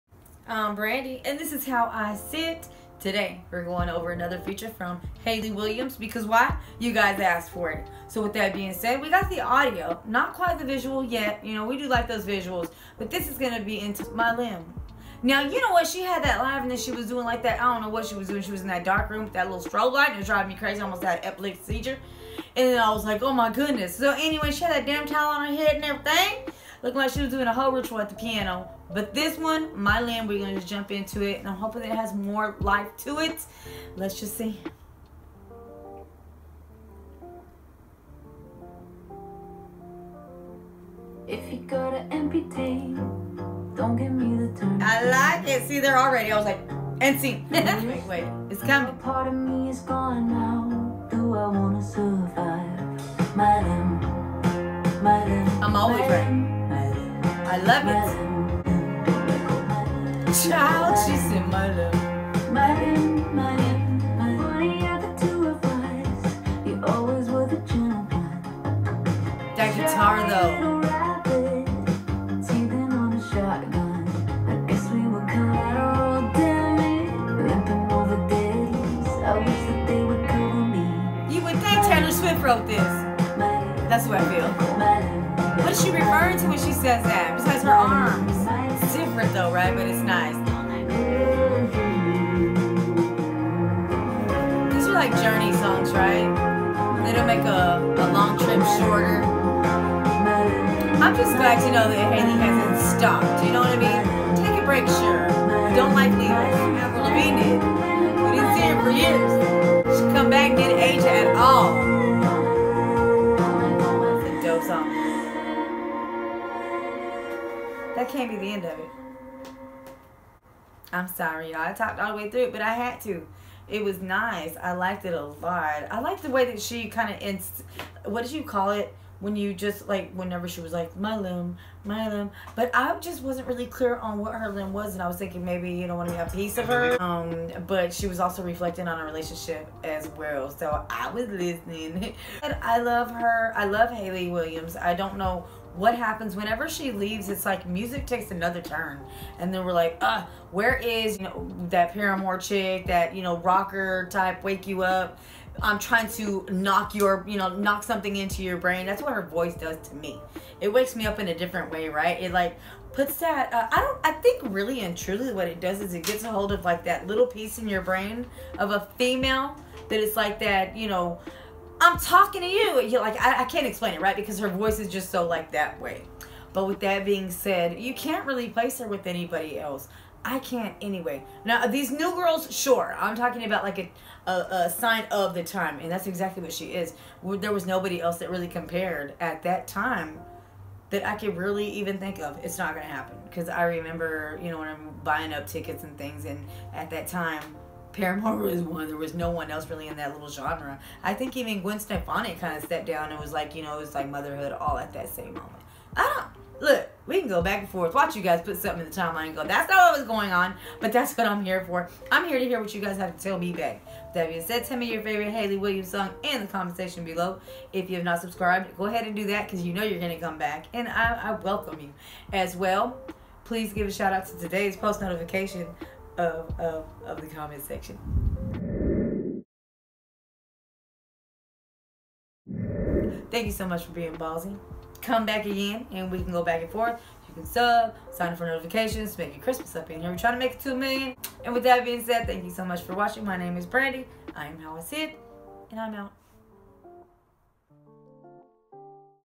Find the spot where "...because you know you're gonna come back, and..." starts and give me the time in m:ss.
3:39.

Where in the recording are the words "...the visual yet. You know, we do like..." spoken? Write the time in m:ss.
0:10.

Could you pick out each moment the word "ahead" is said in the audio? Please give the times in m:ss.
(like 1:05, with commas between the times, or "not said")
3:38.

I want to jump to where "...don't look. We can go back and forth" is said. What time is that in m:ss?
3:26.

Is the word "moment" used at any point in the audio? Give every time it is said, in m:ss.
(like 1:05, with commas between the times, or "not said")
3:25.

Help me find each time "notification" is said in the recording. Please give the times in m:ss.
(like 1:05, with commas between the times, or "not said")
3:45, 3:58.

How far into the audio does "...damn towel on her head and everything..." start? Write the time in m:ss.
0:24.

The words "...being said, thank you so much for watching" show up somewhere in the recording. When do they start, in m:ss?
4:01.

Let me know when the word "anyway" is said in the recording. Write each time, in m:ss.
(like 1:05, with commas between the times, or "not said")
0:24, 3:00.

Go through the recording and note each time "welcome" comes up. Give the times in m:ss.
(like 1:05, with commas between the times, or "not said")
3:41.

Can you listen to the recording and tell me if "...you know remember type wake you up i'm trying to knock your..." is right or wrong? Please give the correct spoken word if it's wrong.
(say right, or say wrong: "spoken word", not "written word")
wrong: "rocker", not "remember".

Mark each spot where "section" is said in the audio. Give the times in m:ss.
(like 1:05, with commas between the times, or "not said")
3:36, 3:47.